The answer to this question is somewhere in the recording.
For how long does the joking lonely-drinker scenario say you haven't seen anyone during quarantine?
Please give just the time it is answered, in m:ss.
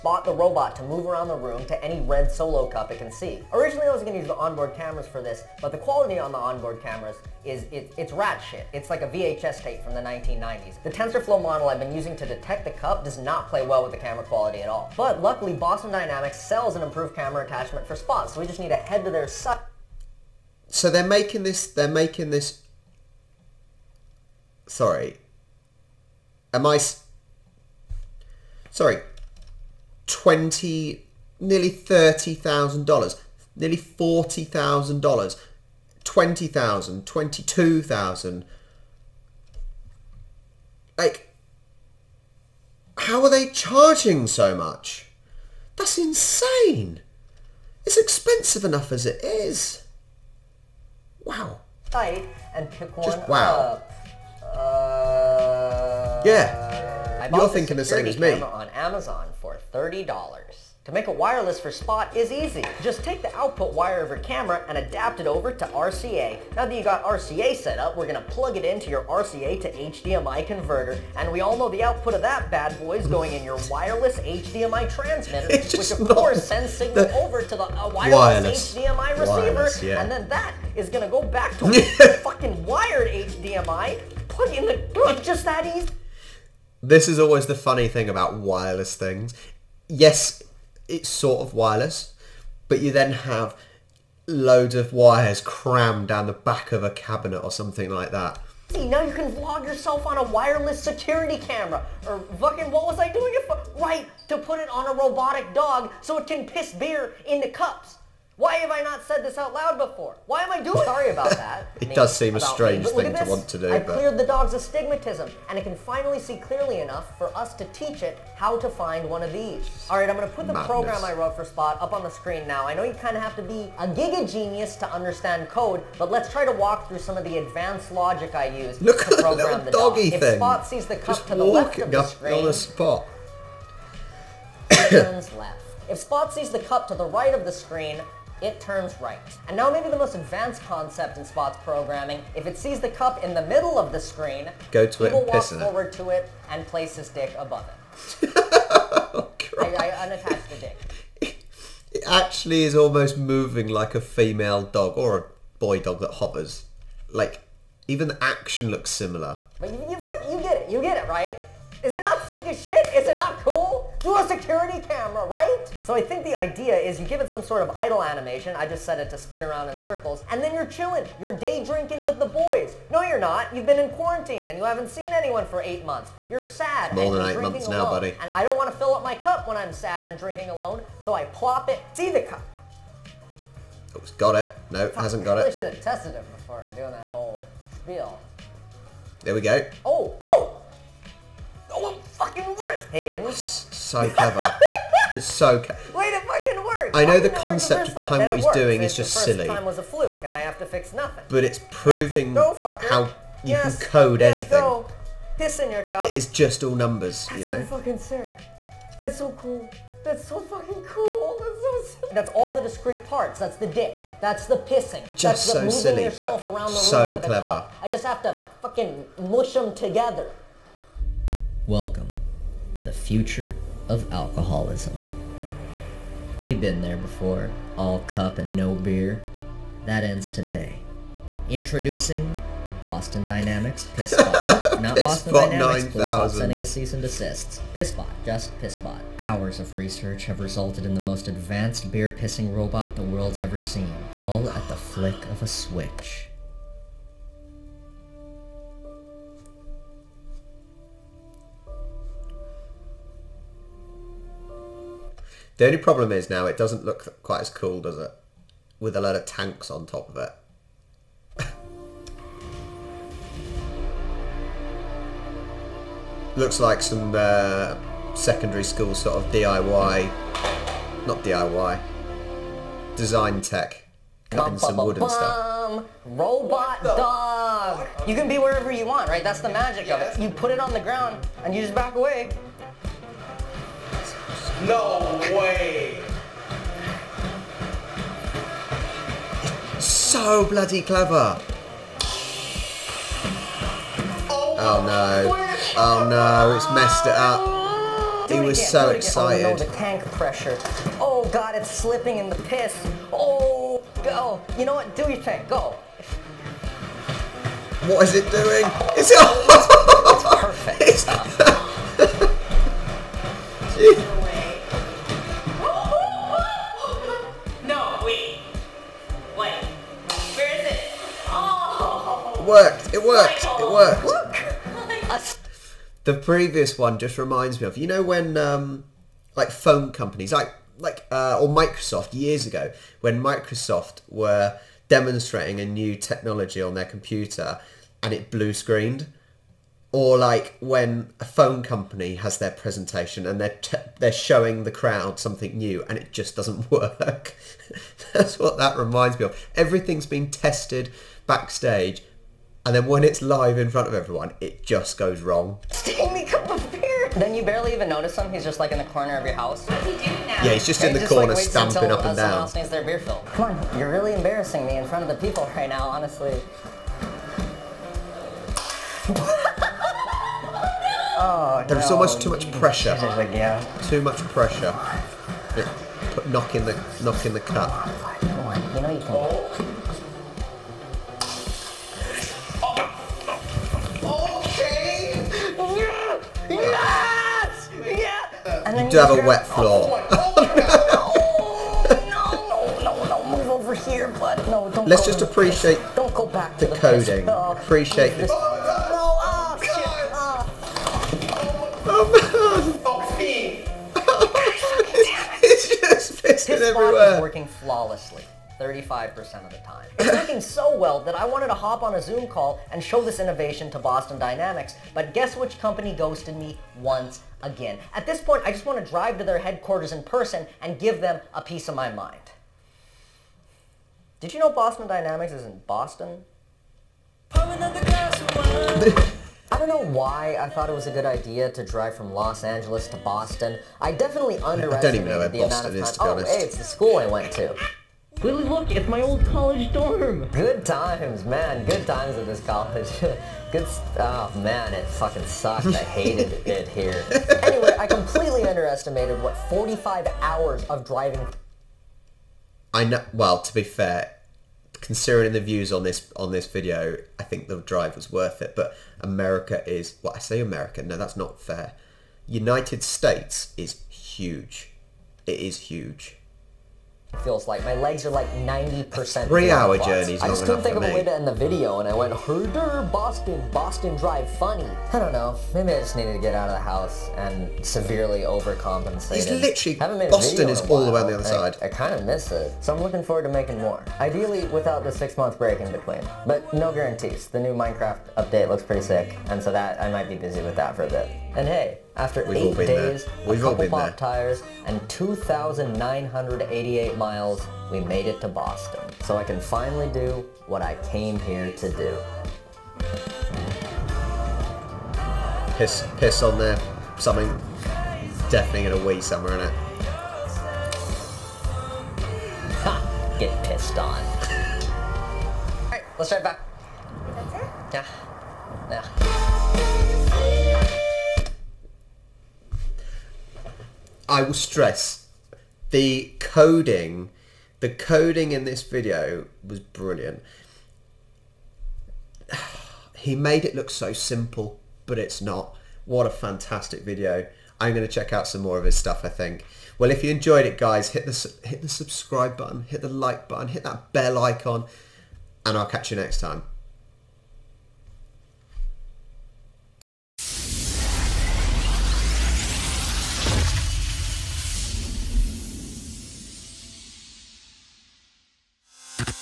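2:55.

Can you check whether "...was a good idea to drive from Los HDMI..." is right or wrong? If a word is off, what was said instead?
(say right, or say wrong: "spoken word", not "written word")
wrong: "Angeles", not "HDMI".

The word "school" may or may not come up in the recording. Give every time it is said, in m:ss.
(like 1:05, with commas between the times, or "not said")
4:28, 7:16.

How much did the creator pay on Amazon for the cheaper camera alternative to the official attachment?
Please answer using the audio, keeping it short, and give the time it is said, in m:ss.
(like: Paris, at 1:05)
$30, at 0:59.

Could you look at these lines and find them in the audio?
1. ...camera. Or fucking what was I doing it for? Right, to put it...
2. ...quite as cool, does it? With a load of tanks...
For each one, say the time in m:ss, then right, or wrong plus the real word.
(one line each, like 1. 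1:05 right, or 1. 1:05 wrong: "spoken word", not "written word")
1. 1:41 right
2. 4:17 right.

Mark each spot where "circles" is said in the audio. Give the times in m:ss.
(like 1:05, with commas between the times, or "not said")
2:49.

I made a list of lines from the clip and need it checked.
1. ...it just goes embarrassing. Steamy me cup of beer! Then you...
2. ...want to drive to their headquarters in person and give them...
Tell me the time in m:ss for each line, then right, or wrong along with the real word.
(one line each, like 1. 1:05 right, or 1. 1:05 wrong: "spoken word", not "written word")
1. 5:54 wrong: "wrong", not "embarrassing"
2. 6:58 right.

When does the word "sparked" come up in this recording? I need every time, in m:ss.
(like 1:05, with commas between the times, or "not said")
not said.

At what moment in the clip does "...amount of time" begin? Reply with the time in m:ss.
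7:15.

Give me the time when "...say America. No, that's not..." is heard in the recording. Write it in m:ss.
7:40.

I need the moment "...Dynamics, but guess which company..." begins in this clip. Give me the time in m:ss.
6:54.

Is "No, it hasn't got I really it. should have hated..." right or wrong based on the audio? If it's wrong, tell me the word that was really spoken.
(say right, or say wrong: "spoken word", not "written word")
wrong: "tested", not "hated".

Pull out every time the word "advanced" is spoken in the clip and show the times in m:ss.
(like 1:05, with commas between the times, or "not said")
2:07, 2:20, 4:01.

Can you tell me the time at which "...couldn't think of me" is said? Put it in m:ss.
7:50.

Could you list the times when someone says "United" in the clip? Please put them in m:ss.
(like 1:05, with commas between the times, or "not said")
7:42.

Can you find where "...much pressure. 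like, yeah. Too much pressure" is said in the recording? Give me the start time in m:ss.
6:12.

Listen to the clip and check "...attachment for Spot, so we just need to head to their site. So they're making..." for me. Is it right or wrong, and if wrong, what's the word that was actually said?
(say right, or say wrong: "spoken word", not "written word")
right.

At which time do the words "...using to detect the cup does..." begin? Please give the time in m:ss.
0:11.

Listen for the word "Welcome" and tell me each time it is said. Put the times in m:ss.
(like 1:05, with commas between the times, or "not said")
3:41.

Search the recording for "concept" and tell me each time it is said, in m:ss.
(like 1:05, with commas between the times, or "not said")
2:20, 3:17.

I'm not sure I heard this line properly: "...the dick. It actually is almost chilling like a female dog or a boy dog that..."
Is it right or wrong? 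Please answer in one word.
wrong.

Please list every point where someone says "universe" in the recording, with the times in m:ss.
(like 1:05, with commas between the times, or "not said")
not said.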